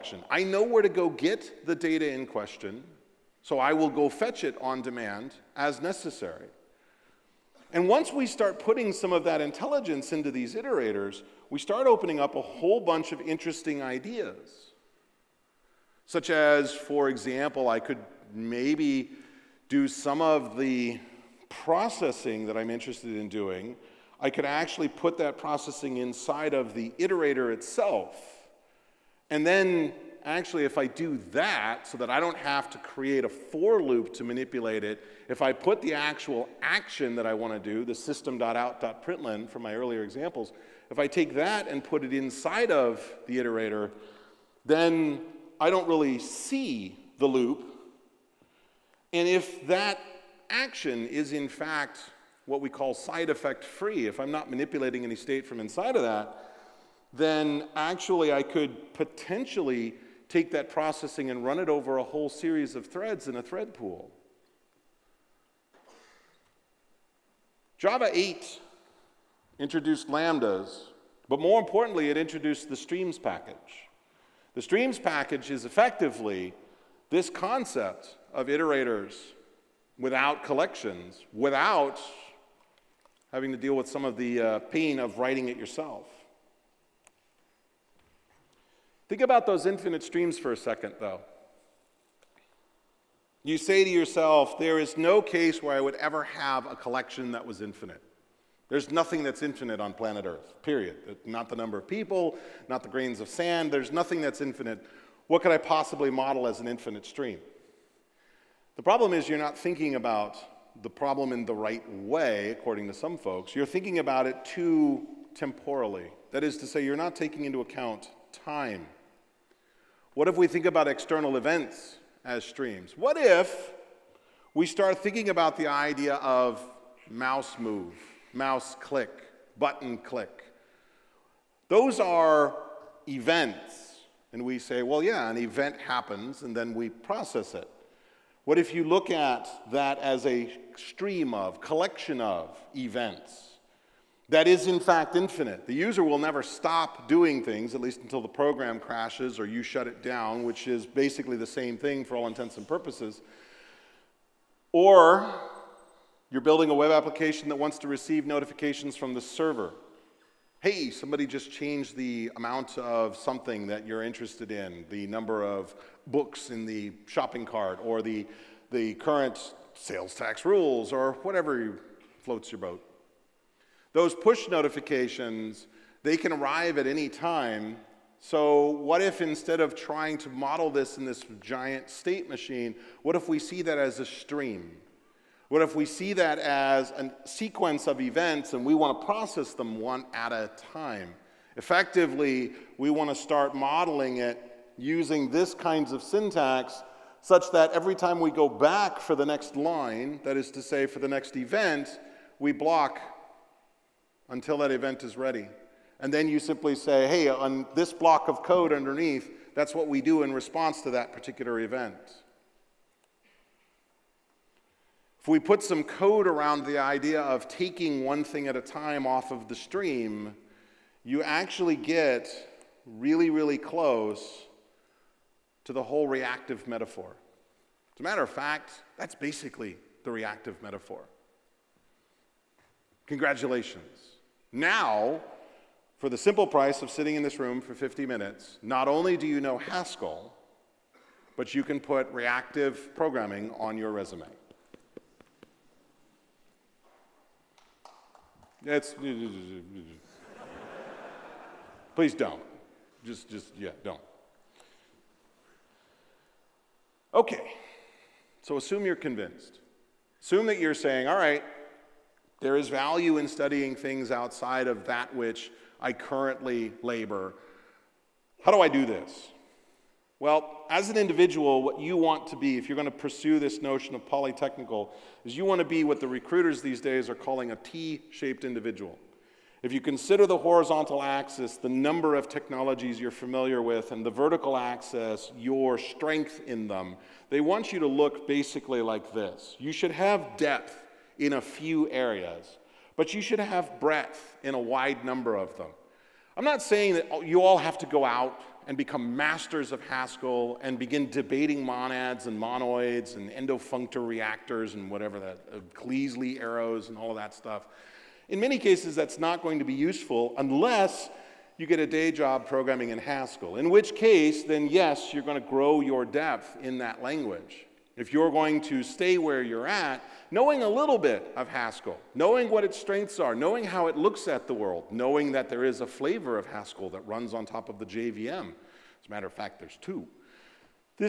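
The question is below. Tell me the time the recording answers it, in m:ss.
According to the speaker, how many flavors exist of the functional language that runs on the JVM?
5:29.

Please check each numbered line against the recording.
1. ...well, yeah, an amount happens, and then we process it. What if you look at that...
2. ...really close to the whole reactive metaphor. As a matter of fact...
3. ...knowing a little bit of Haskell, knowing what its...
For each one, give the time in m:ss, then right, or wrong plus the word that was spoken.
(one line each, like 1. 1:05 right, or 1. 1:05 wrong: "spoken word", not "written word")
1. 2:14 wrong: "event", not "amount"
2. 3:43 right
3. 5:20 right.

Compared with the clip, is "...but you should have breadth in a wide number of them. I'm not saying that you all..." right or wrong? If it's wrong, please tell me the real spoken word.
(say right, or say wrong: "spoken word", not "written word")
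right.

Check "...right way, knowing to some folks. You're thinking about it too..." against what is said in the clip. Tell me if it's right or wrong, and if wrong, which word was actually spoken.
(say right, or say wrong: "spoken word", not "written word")
wrong: "according", not "knowing".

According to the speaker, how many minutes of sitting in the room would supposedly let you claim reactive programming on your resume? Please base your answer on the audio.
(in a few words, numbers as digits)
50.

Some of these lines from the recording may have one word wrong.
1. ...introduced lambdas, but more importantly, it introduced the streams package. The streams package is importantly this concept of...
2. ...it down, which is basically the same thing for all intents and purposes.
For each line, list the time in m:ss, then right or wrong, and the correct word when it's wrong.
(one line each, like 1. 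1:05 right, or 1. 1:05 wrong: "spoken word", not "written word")
1. 1:09 wrong: "effectively", not "importantly"
2. 2:29 right.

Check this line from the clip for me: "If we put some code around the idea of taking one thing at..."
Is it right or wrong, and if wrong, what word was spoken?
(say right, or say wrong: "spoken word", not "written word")
right.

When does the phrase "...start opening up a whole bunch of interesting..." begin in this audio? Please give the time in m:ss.
0:11.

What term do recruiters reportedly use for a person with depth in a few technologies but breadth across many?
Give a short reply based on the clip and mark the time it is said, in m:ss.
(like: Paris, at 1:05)
T shaped individual, at 4:37.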